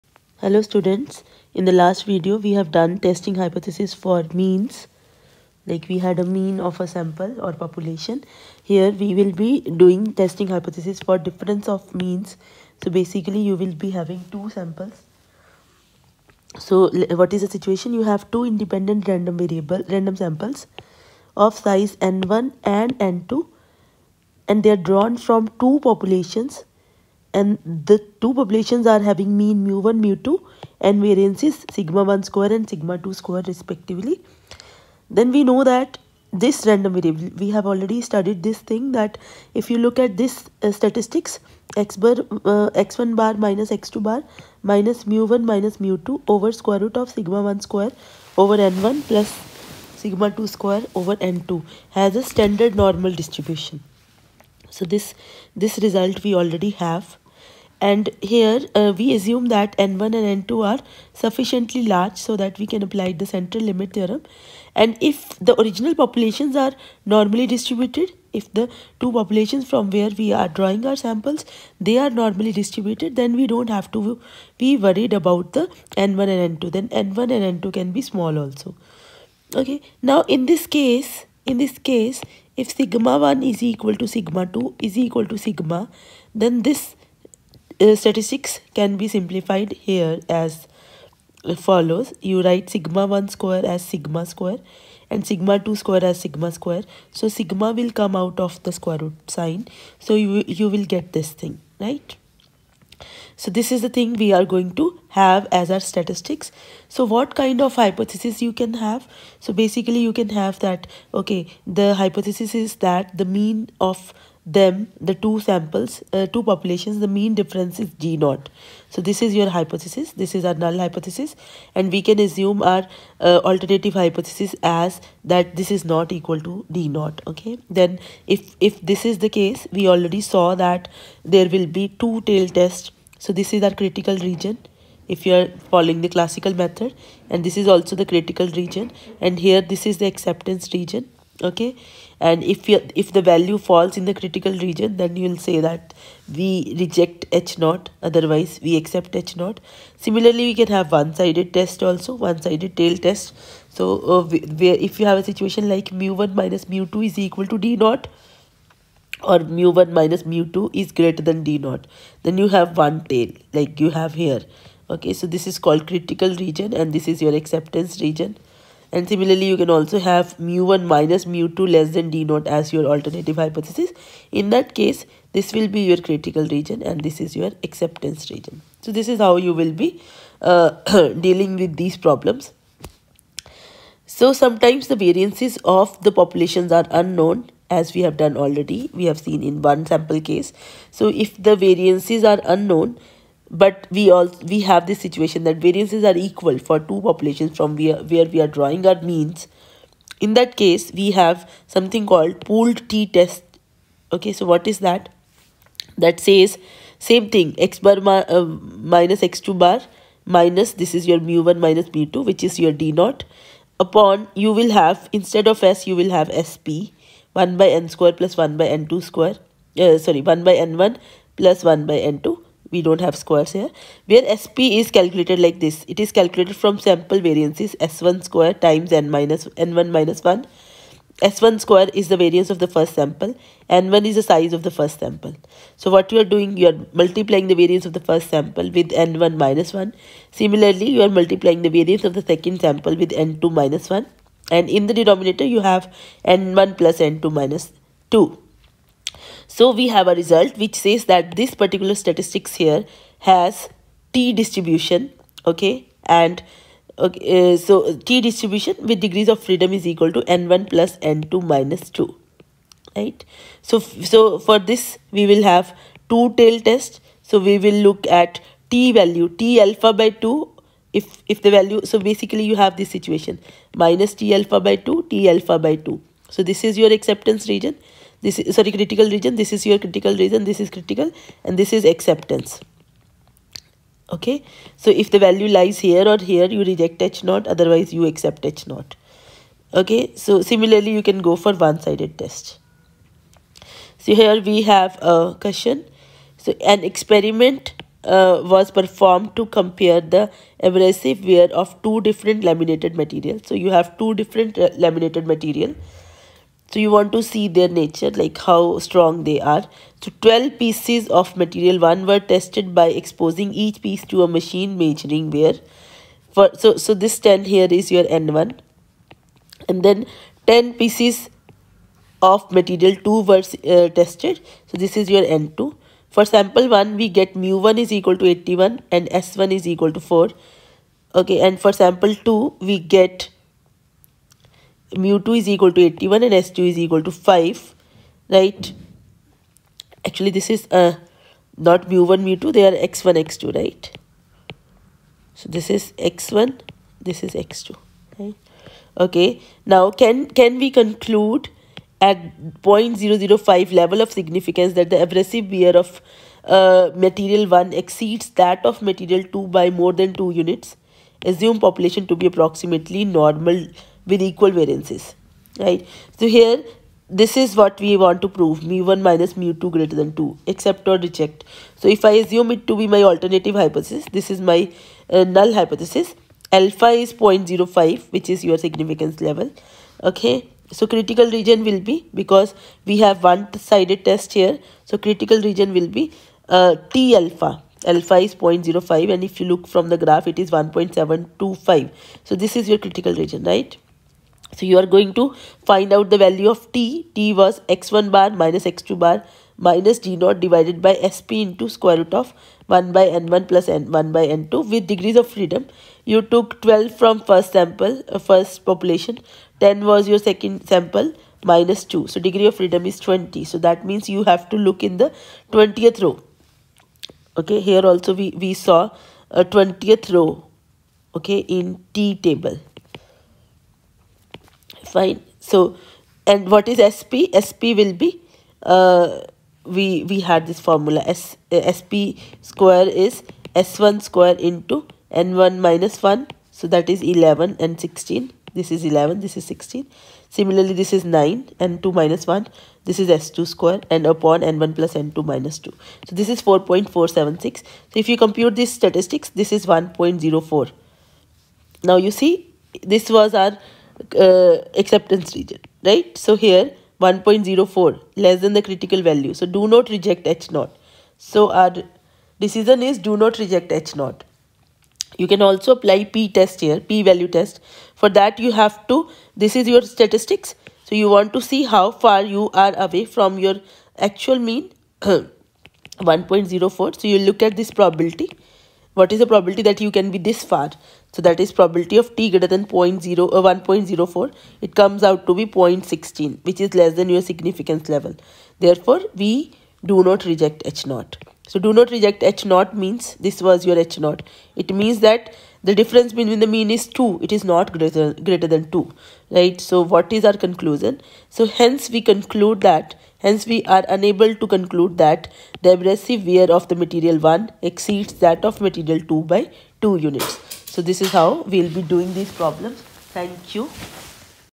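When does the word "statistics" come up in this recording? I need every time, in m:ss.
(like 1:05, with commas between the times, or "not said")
0:40, 1:27, 1:45, 4:12, 7:28, 7:49.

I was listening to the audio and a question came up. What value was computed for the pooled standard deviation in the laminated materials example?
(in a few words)
4.476.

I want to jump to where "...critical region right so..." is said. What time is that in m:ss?
6:32.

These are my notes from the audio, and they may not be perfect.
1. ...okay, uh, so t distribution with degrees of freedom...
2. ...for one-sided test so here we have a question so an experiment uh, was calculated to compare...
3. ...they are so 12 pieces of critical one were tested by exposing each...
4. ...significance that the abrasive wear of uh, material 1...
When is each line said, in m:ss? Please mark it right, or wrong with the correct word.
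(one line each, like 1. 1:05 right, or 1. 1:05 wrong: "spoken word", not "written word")
1. 4:16 right
2. 4:51 wrong: "performed", not "calculated"
3. 5:09 wrong: "material", not "critical"
4. 5:54 right.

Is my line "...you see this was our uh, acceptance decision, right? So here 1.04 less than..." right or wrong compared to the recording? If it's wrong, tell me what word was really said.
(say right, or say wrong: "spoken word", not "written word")
wrong: "region", not "decision".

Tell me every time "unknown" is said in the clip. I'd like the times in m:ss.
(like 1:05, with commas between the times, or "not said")
3:06, 3:12.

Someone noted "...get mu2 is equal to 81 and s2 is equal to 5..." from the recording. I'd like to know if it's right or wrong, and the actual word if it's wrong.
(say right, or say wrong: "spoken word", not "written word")
right.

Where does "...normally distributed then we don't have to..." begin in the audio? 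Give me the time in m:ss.
1:12.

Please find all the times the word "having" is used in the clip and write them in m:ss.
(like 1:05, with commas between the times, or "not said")
0:13, 0:28.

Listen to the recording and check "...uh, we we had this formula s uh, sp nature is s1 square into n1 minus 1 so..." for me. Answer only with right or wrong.
wrong.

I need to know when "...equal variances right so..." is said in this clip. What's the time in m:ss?
6:04.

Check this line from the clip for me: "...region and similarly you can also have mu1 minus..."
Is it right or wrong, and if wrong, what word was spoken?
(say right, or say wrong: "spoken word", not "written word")
right.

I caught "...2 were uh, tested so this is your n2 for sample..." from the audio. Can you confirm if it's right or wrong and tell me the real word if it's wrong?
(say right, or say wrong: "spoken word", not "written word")
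right.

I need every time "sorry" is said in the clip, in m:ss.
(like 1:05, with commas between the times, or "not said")
3:39, 4:38.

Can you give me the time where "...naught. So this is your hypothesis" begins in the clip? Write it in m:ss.
1:58.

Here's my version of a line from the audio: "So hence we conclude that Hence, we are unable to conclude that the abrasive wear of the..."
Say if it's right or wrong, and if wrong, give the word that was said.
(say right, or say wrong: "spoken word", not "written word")
right.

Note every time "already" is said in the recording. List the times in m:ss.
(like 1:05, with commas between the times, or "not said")
0:37, 0:56, 2:09, 3:08.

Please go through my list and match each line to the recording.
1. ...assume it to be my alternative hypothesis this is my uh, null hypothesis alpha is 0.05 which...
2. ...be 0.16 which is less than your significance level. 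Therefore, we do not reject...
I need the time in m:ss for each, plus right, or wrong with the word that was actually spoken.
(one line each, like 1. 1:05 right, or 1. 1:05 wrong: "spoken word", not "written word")
1. 6:12 right
2. 8:05 right.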